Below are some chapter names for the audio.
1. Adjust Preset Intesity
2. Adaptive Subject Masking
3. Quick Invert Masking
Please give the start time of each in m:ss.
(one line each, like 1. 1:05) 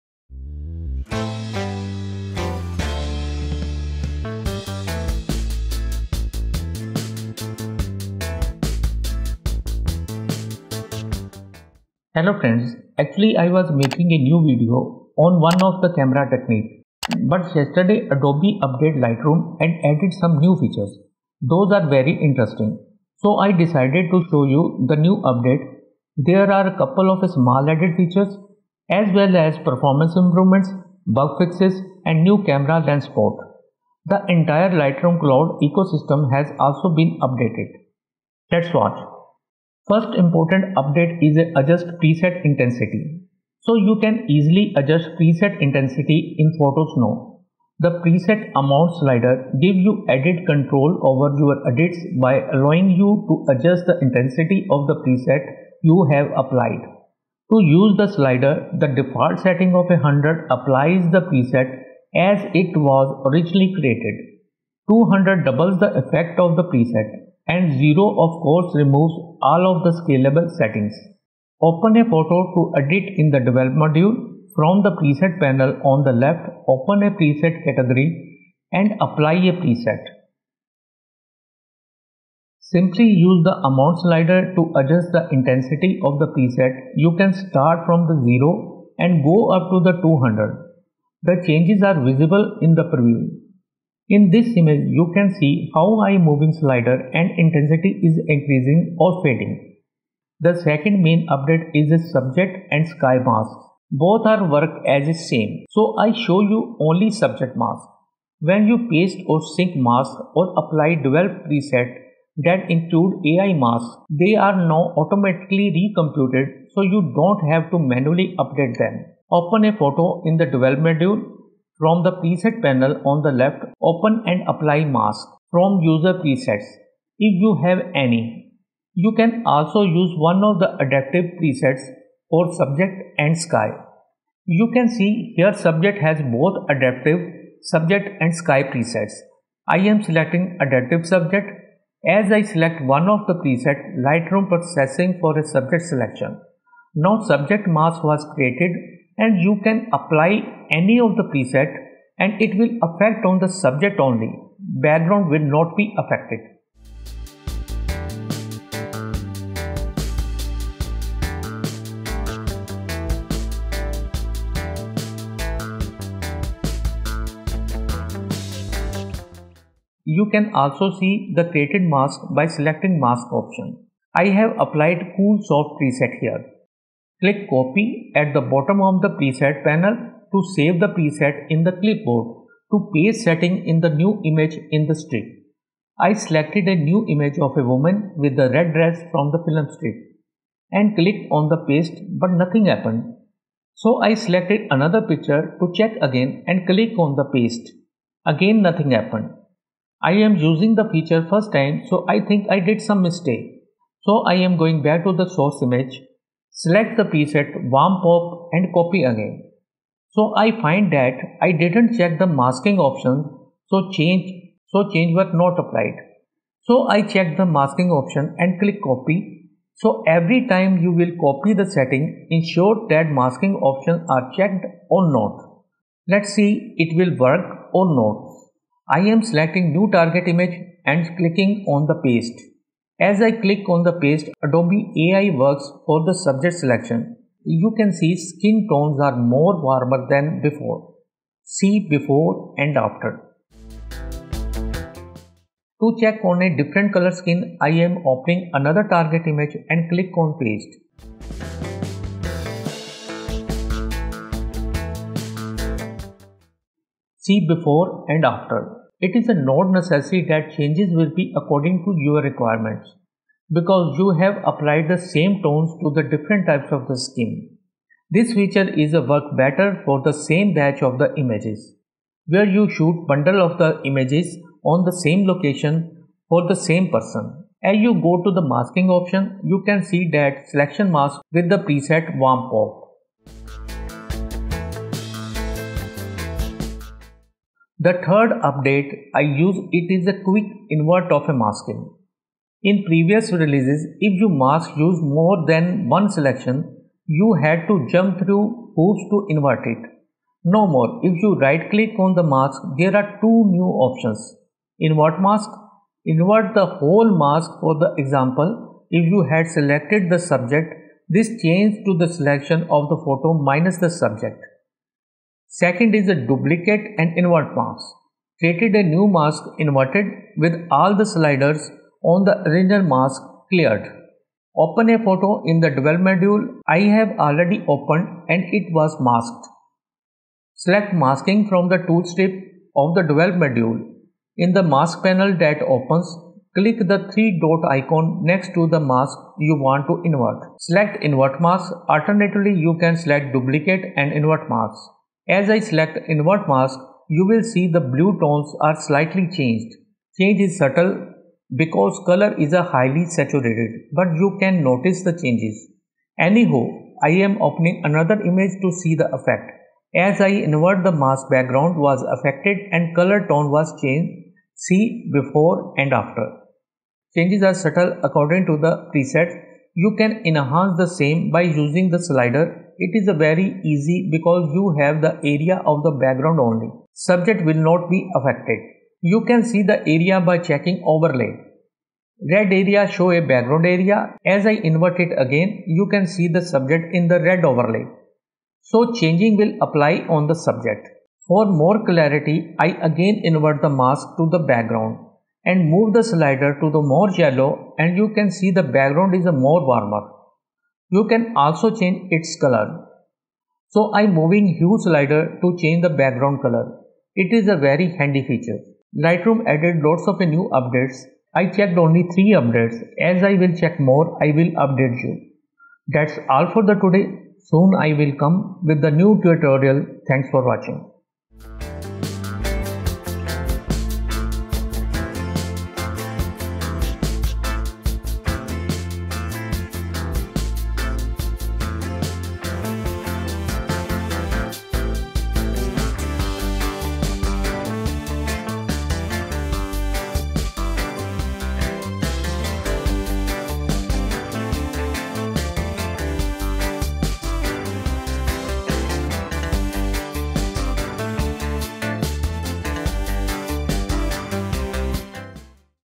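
1. 0:44
2. 1:45
3. 4:48.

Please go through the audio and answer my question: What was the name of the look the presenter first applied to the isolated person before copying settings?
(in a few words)
cool soft.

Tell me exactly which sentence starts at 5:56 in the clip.
Anyhow, I am opening another image to see the effect.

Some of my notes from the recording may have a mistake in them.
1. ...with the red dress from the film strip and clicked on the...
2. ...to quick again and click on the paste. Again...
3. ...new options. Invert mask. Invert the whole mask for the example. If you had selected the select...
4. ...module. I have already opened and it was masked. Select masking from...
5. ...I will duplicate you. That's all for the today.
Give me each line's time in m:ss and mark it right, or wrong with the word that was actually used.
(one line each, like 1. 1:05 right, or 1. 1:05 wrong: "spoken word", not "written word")
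1. 3:08 right
2. 3:15 wrong: "check", not "quick"
3. 5:03 wrong: "subject", not "select"
4. 5:25 right
5. 6:54 wrong: "update", not "duplicate".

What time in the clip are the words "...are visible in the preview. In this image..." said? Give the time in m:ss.
1:31.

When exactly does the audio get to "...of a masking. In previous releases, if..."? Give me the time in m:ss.
4:51.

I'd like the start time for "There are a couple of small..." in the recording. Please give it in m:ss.
0:26.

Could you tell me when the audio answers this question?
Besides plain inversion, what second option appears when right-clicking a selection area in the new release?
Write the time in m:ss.
5:16.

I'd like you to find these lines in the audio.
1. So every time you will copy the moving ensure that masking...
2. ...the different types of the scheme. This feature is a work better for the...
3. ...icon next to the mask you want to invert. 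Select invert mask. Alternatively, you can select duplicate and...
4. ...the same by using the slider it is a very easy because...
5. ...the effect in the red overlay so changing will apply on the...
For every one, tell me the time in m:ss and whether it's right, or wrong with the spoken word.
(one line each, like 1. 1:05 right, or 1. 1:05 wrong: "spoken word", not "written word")
1. 3:39 wrong: "setting", not "moving"
2. 4:25 right
3. 5:37 right
4. 6:10 right
5. 6:26 wrong: "subject", not "effect".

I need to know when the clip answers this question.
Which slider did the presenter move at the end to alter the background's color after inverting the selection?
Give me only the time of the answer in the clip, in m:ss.
6:44.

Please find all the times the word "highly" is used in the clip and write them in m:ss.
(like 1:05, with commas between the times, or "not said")
5:52.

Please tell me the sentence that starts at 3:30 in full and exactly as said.
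So I find that I didn't check the masking option so change so change was not applied.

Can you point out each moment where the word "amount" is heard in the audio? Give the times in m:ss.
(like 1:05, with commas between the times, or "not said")
0:48, 1:23.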